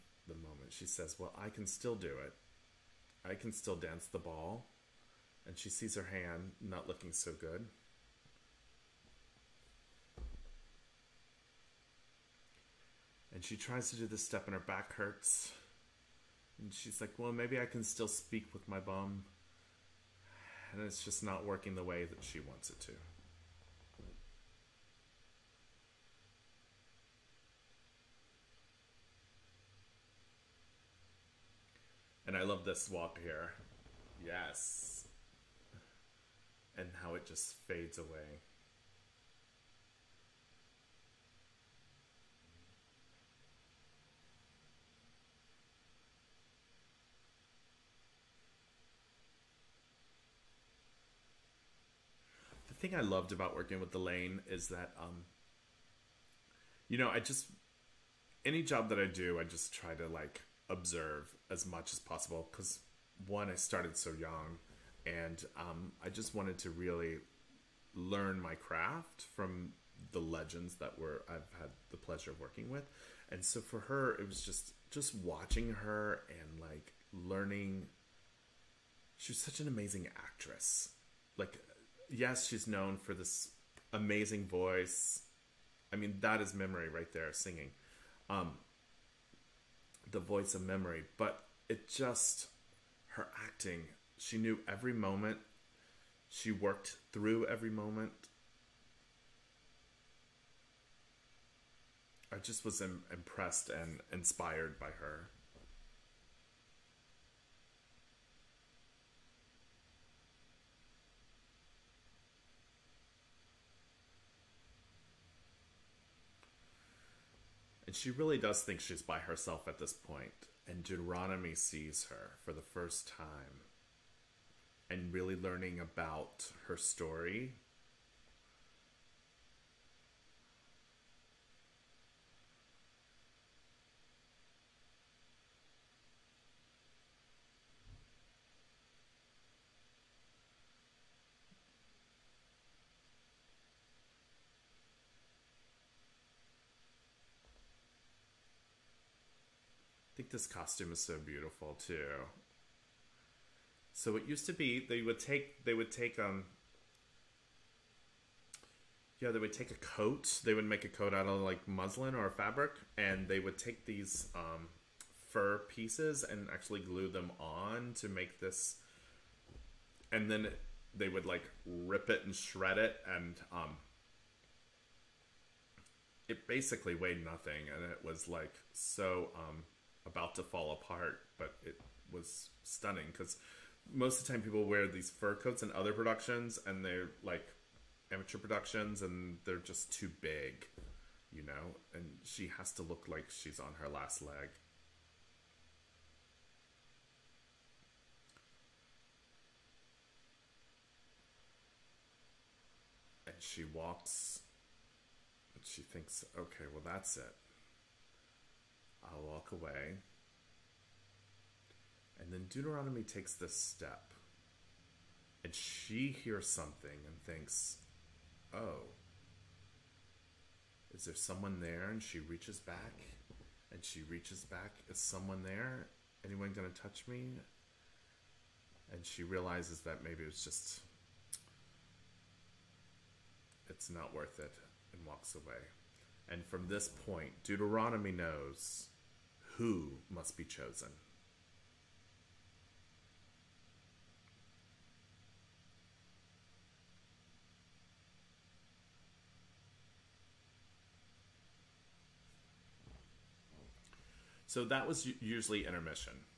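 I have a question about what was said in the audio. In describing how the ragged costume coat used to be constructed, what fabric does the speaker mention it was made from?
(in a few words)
Muslin.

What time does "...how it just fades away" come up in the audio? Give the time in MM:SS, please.
00:37.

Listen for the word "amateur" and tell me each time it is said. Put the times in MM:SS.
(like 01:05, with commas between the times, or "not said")
03:08.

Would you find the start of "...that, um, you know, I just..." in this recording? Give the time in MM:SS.
00:54.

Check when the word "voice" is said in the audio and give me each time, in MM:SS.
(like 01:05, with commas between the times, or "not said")
01:24, 01:30.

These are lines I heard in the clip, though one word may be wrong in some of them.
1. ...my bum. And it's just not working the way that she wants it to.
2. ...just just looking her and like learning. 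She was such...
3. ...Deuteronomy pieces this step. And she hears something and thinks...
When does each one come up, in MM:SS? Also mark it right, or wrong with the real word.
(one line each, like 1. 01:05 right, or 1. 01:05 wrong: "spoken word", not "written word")
1. 00:18 right
2. 01:14 wrong: "watching", not "looking"
3. 03:32 wrong: "takes", not "pieces".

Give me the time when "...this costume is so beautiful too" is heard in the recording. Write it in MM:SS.
02:30.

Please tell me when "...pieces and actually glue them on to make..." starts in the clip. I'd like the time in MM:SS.
02:45.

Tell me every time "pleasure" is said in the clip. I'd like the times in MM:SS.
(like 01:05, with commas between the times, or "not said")
01:11.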